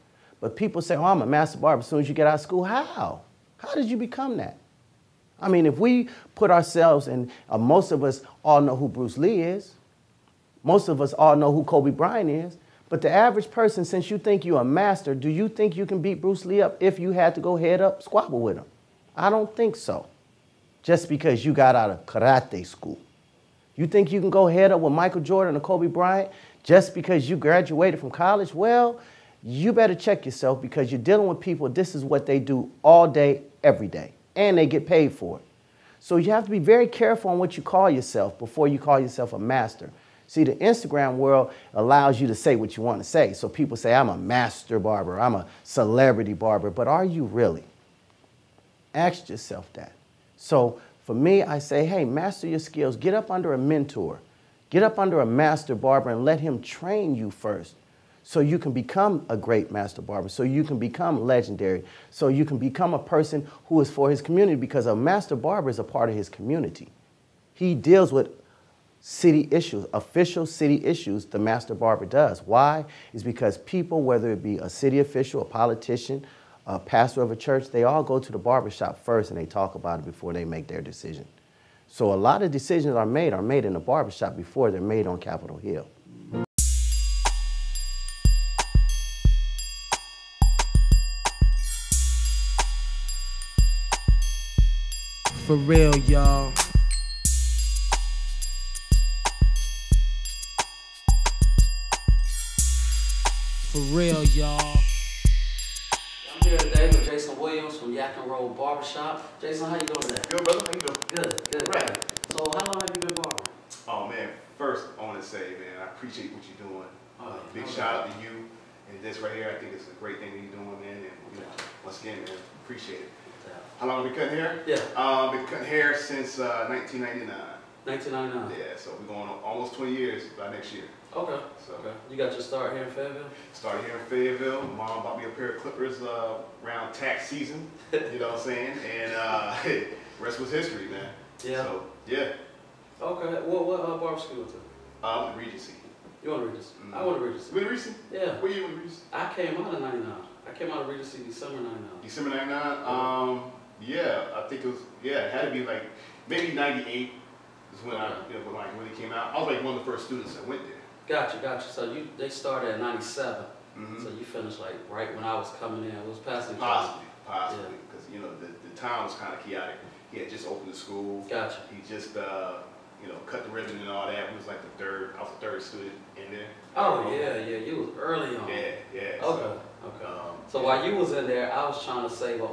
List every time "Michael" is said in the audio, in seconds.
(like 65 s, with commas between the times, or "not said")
24 s.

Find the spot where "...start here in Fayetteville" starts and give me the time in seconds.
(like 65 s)
132 s.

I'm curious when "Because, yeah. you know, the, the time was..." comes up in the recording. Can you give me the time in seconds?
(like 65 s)
167 s.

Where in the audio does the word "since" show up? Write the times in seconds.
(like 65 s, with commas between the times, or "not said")
13 s, 125 s.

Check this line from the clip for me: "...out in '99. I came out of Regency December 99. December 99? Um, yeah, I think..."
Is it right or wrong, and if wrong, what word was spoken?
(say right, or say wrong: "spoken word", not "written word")
right.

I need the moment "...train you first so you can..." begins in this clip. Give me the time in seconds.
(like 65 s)
56 s.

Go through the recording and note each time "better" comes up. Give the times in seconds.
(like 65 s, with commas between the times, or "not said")
29 s.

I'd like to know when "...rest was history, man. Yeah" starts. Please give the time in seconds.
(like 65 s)
140 s.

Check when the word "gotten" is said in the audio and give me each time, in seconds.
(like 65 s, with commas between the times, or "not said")
not said.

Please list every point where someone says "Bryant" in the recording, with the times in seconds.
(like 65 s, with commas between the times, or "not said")
11 s, 25 s.